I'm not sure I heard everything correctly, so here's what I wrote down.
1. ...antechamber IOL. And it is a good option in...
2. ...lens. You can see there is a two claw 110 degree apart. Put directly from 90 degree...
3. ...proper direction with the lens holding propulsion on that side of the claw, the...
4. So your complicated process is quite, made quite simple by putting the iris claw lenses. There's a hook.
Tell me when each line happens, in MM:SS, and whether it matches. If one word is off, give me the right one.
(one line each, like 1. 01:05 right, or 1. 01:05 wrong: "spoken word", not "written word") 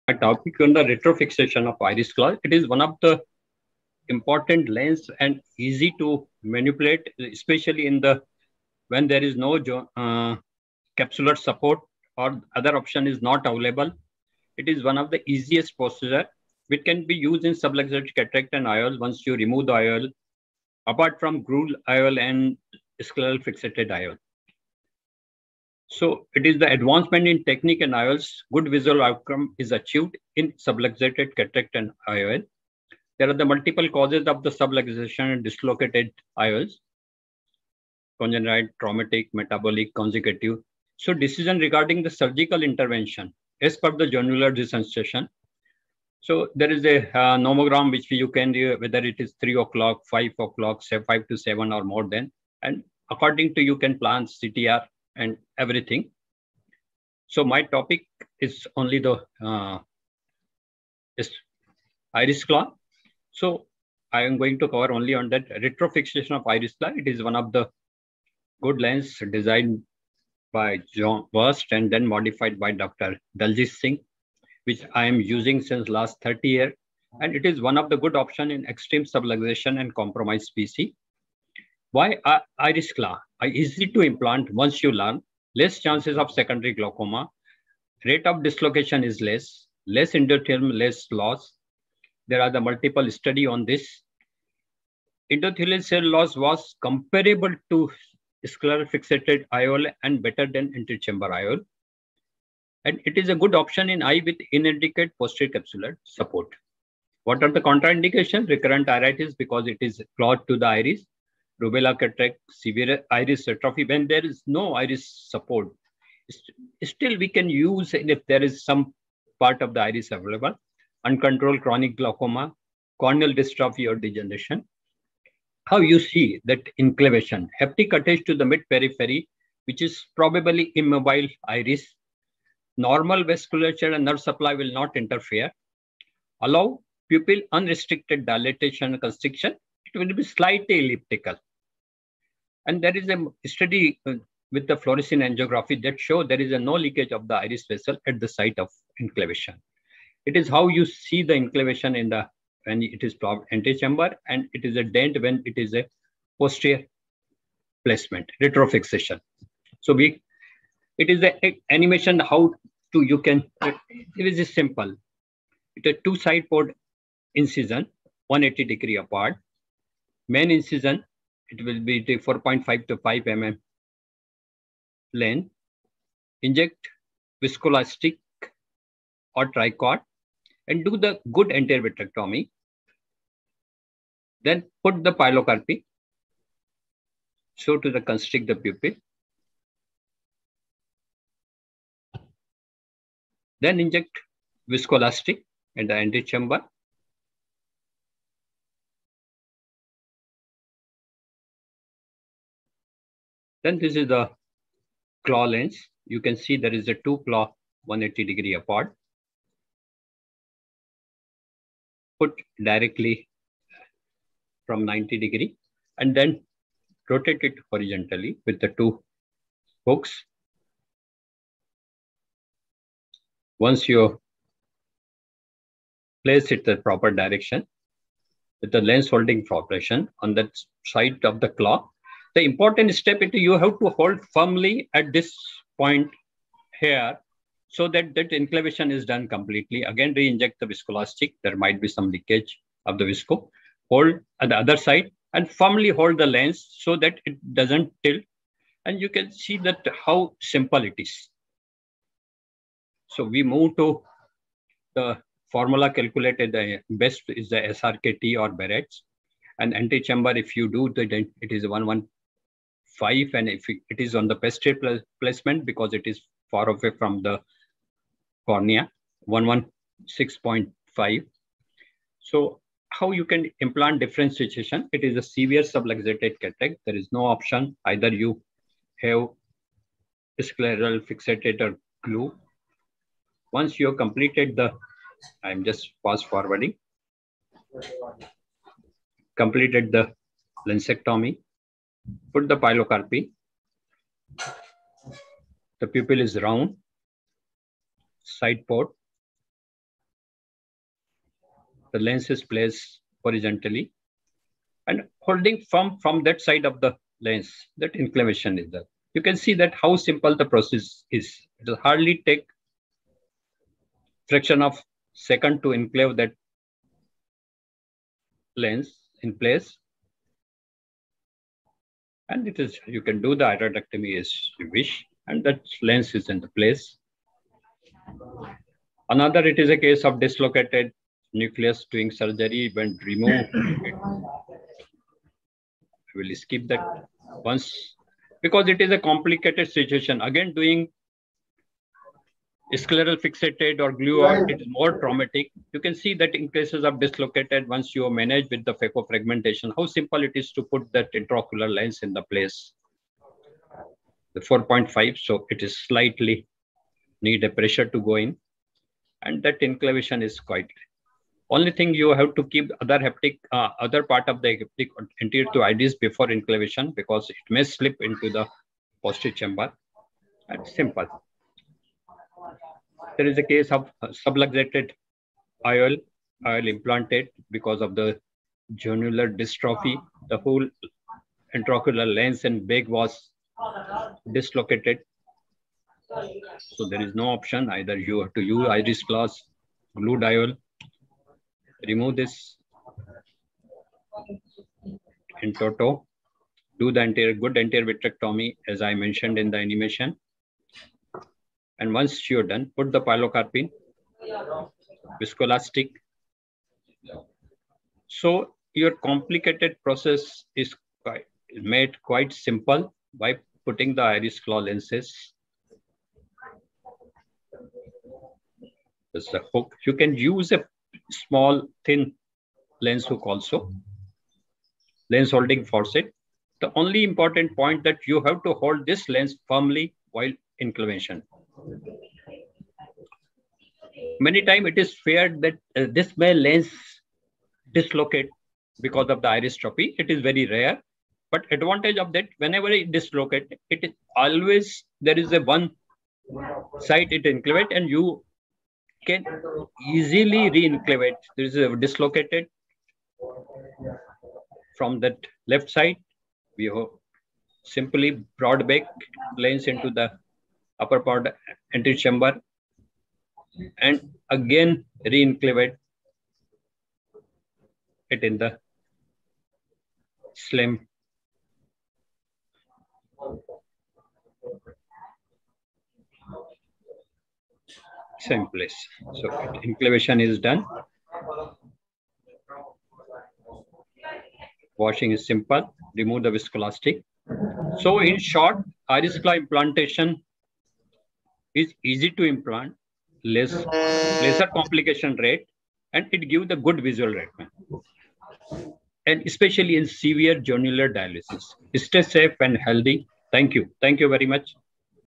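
1. 01:40 right
2. 03:25 wrong: "180", not "110"
3. 03:46 right
4. 06:48 right.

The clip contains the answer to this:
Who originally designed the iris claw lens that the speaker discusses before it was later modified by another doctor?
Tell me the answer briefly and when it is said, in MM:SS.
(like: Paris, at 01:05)
John Worst, at 01:10.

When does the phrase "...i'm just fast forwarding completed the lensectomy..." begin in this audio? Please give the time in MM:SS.
04:45.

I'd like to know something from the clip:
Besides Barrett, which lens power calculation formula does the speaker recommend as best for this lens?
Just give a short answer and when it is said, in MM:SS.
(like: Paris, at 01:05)
SRK/T, at 04:17.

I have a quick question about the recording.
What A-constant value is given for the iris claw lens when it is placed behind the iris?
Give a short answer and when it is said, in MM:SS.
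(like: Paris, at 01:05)
116.5, at 04:29.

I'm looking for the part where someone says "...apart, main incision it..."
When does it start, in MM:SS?
02:48.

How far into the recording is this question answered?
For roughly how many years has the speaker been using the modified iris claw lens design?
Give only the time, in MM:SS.
01:16.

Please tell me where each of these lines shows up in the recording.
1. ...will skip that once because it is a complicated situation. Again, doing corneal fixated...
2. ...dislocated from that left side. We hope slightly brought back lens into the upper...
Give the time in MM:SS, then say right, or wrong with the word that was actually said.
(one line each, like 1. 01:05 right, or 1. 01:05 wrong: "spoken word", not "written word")
1. 05:36 wrong: "scleral", not "corneal"
2. 07:31 wrong: "simply", not "slightly".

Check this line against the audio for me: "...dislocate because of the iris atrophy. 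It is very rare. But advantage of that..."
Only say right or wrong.
right.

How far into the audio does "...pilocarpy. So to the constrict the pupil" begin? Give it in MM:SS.
03:05.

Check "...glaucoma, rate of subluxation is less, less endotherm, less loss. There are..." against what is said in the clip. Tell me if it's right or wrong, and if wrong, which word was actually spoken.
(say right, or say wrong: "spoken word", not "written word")
wrong: "dislocation", not "subluxation".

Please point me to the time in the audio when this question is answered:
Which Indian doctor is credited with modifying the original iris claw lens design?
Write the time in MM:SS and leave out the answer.
01:12.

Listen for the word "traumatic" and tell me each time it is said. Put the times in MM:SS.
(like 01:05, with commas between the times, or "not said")
00:38, 05:44.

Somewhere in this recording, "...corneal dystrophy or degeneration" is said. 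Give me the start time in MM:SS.
02:02.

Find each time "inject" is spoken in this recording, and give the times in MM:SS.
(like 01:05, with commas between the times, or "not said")
02:56, 03:13, 04:00.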